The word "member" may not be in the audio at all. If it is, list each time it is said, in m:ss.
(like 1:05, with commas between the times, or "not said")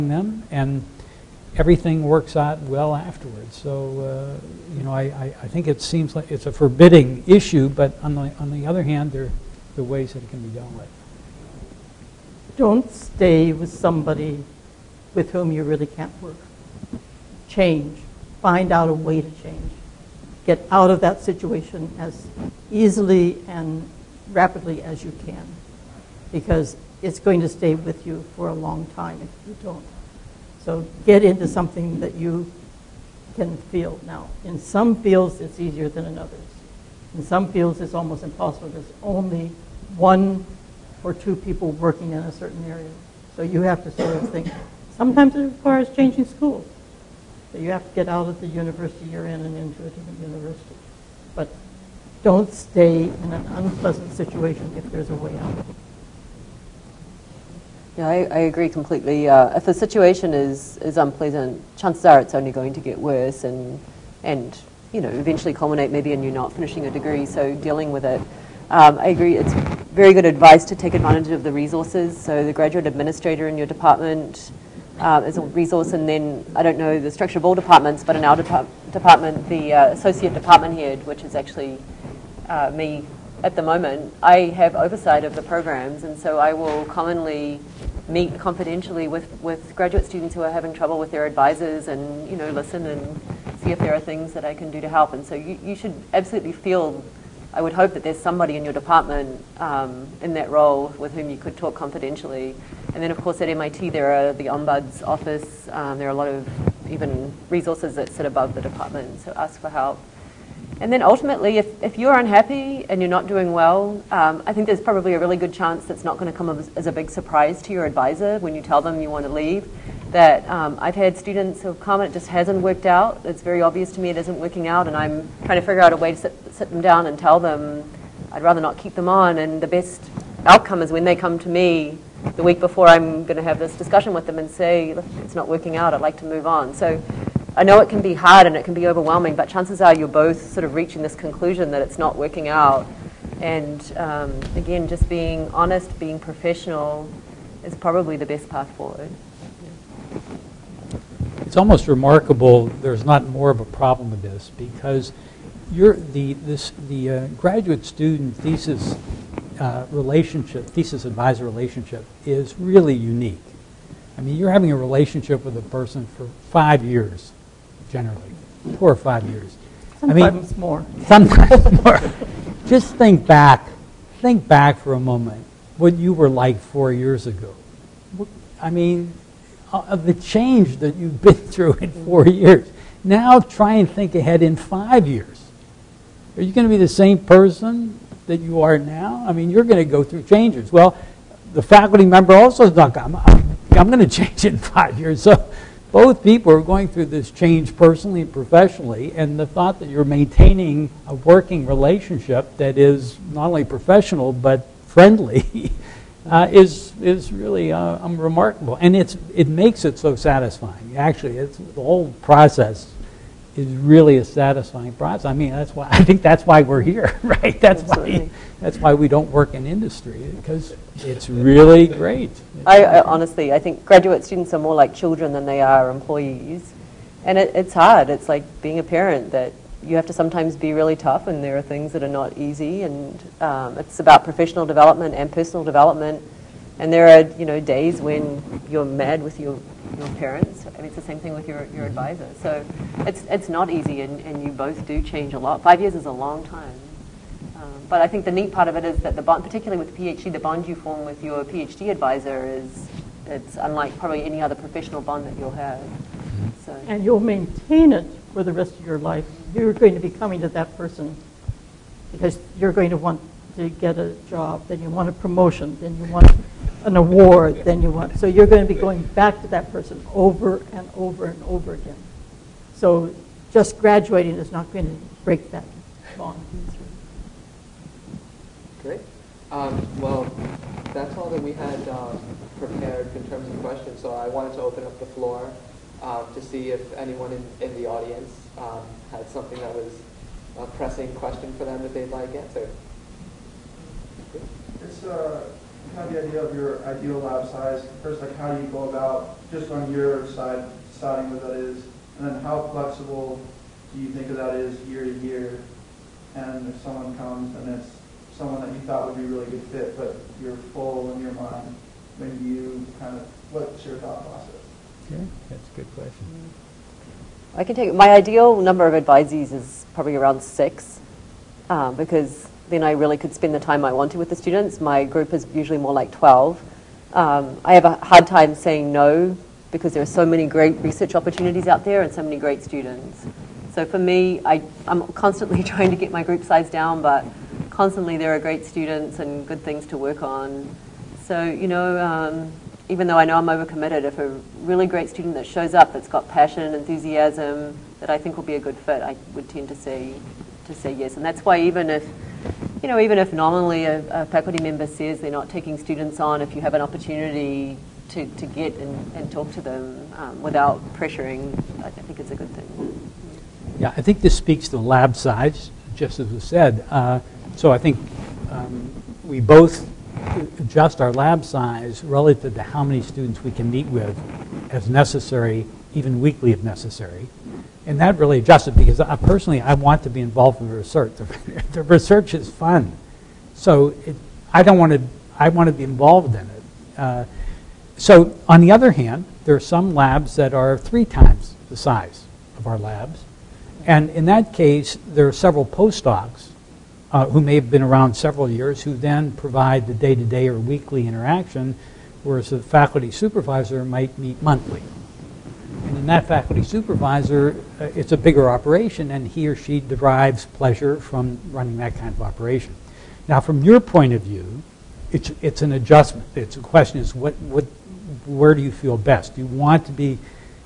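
3:12, 5:54.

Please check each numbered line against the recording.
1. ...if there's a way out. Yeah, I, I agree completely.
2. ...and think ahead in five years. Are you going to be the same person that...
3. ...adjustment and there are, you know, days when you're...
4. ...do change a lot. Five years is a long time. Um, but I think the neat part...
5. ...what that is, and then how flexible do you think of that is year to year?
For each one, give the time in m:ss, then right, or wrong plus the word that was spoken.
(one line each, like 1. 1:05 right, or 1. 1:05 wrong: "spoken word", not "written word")
1. 0:54 right
2. 3:03 right
3. 3:55 wrong: "development", not "adjustment"
4. 4:04 right
5. 5:01 right.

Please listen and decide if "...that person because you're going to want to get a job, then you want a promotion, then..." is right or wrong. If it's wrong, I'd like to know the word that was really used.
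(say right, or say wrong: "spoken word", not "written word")
right.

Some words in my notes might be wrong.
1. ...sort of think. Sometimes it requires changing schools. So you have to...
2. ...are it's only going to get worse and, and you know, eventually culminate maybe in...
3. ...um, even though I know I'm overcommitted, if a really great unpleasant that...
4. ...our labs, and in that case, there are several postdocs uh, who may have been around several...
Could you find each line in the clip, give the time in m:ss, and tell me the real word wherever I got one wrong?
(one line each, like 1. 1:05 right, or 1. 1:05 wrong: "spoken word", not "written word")
1. 0:43 right
2. 1:02 right
3. 5:42 wrong: "student", not "unpleasant"
4. 6:32 right.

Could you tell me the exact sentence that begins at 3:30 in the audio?
Actually, it's the whole process is really a satisfying process.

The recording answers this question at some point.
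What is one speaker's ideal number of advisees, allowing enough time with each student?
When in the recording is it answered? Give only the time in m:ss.
5:20.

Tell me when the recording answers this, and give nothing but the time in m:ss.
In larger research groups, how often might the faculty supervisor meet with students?
6:44.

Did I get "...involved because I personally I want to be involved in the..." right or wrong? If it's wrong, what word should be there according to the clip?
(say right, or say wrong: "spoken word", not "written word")
wrong: "adjusted", not "involved".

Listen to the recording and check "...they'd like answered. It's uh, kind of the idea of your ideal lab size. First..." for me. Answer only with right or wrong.
right.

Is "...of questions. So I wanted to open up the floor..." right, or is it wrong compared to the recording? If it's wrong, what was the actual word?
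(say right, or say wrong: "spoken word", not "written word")
right.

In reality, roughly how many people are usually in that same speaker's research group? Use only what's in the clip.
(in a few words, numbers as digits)
12.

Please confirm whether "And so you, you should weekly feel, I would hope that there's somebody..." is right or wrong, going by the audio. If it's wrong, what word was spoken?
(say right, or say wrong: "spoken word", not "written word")
wrong: "absolutely", not "weekly".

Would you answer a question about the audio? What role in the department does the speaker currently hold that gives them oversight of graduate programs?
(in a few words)
Associate department head.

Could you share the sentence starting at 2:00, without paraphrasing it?
That um, I've had students who have come and it just hasn't worked out.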